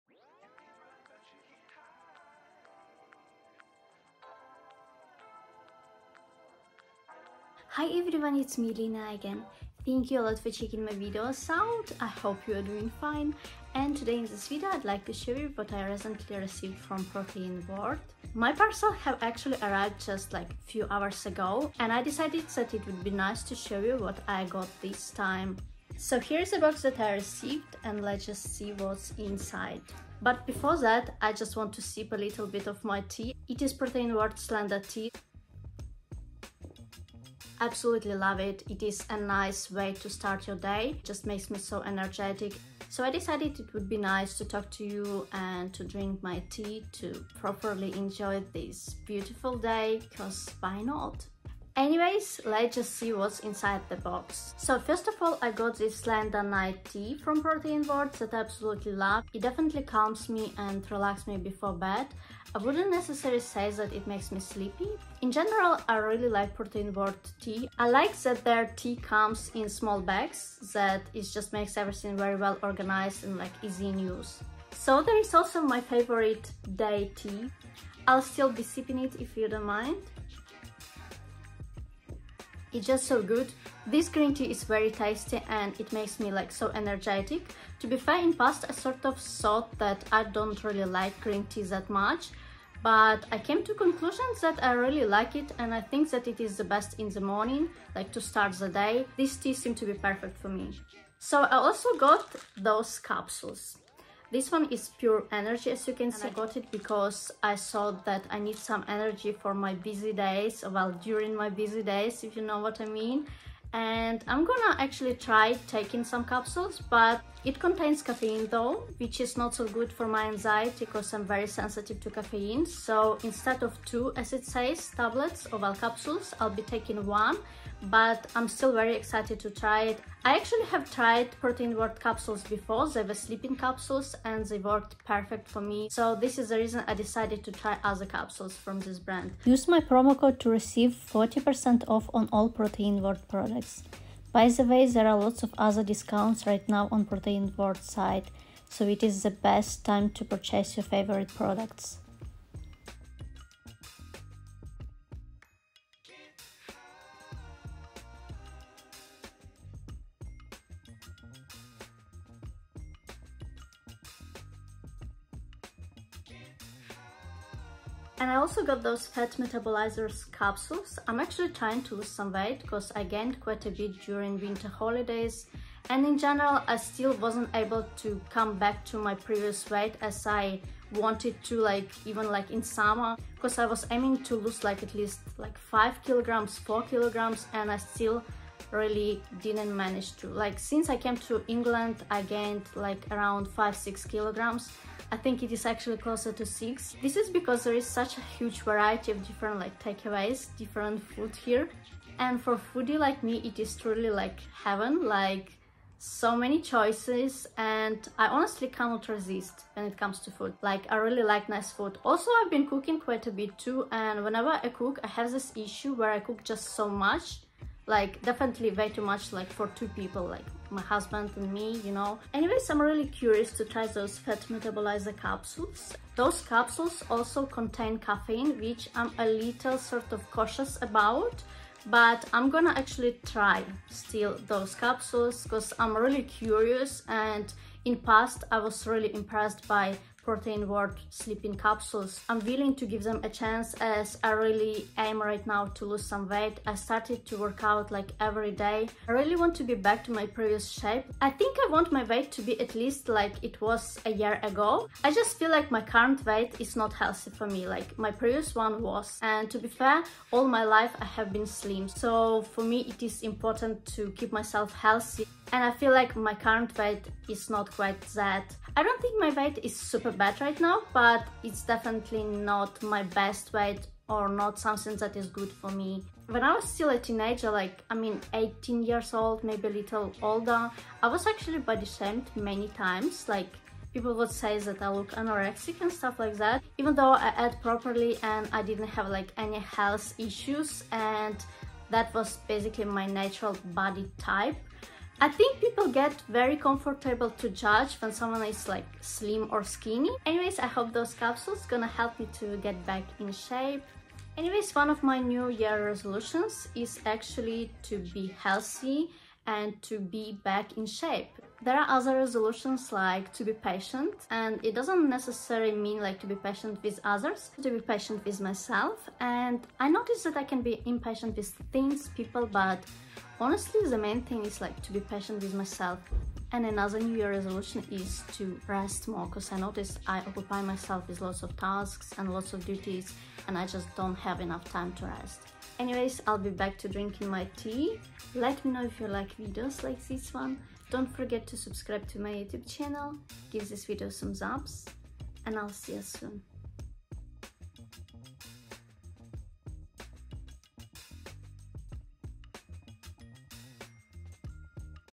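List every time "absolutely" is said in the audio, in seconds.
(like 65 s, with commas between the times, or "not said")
37 s, 58 s.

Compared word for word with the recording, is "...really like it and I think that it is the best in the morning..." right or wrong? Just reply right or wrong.
right.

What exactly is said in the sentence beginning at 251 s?
I think I want my weight to be at least like it was a year ago.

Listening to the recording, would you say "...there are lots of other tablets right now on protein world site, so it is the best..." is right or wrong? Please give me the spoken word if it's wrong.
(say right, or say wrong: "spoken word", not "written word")
wrong: "discounts", not "tablets".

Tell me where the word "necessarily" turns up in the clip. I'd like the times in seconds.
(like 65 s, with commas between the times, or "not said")
62 s, 315 s.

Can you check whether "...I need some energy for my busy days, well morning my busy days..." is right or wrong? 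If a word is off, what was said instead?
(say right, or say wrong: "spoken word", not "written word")
wrong: "during", not "morning".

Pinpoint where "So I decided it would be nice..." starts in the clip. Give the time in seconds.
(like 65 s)
42 s.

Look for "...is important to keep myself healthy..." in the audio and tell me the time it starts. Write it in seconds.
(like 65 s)
263 s.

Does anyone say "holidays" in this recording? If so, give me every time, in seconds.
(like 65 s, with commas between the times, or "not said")
174 s.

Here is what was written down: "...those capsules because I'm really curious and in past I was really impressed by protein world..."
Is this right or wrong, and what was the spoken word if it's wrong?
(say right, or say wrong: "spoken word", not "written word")
right.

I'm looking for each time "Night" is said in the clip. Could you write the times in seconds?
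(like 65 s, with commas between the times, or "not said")
56 s.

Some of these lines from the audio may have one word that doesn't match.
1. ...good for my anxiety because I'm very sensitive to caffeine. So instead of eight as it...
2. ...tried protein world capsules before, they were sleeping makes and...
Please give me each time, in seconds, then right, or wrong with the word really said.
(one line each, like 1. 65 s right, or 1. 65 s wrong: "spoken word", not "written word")
1. 119 s wrong: "two", not "eight"
2. 130 s wrong: "capsules", not "makes".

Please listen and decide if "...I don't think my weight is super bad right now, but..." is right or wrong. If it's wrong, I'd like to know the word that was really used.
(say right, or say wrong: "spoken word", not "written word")
right.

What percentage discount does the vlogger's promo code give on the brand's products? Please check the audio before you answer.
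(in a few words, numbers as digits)
40%.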